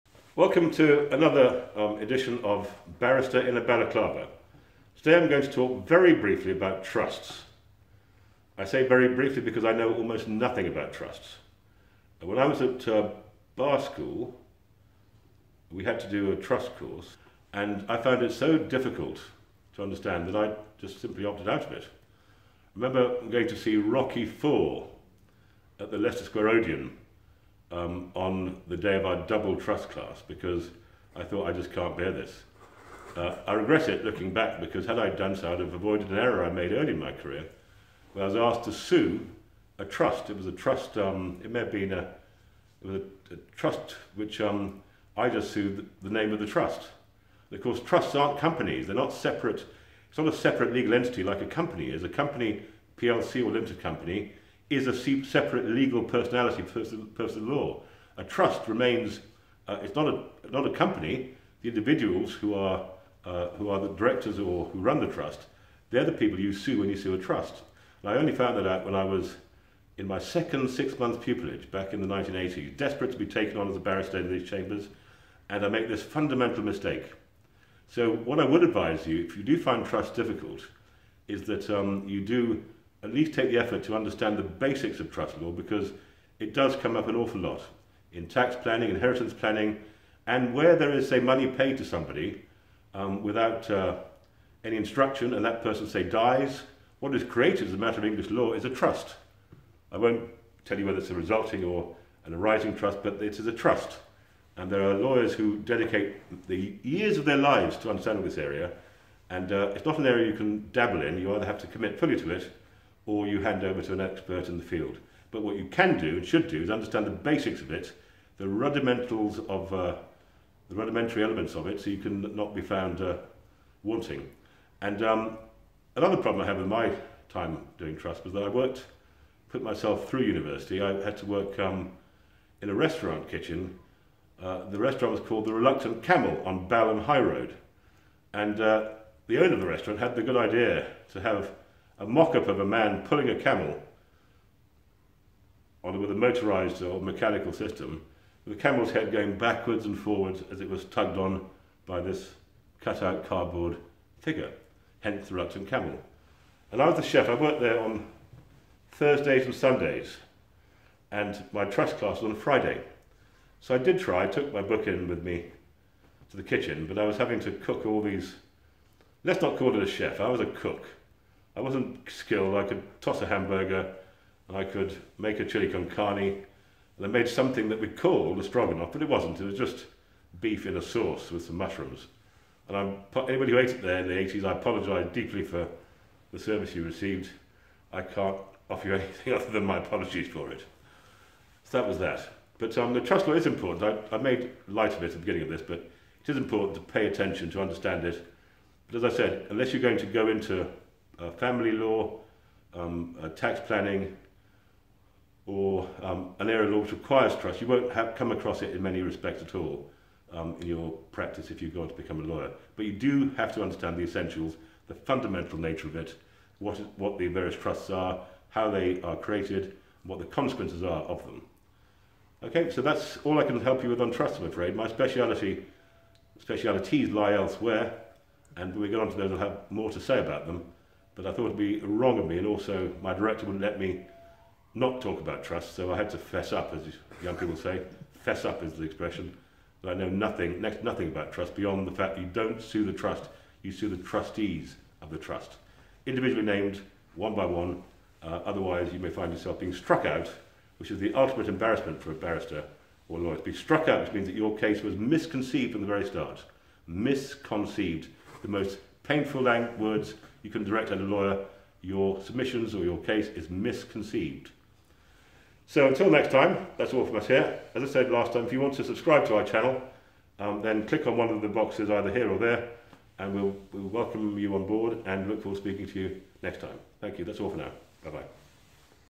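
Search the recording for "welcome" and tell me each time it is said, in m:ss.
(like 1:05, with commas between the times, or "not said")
0:00, 4:33.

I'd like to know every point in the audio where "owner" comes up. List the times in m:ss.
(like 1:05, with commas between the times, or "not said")
2:19.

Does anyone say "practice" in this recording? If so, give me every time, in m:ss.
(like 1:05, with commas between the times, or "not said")
3:31.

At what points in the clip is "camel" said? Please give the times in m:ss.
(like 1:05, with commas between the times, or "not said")
2:16, 2:23, 2:28, 2:35.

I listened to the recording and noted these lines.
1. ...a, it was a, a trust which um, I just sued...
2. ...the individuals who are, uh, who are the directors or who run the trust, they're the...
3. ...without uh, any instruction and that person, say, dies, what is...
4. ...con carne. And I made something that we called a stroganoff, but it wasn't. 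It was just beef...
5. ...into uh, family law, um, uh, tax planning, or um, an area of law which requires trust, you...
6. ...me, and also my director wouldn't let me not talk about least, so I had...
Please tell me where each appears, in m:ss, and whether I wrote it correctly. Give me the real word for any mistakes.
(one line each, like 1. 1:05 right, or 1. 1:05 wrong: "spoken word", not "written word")
1. 0:41 right
2. 1:01 right
3. 1:33 right
4. 2:55 right
5. 3:20 right
6. 3:52 wrong: "trust", not "least".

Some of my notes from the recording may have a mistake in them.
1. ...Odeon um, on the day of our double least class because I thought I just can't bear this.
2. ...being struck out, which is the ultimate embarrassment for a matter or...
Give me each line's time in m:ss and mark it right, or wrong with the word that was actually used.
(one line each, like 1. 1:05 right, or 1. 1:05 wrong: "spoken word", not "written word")
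1. 0:26 wrong: "trust", not "least"
2. 4:09 wrong: "barrister", not "matter".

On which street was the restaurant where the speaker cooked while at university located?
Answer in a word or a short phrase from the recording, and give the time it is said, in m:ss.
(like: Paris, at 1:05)
Balham High Road, at 2:16.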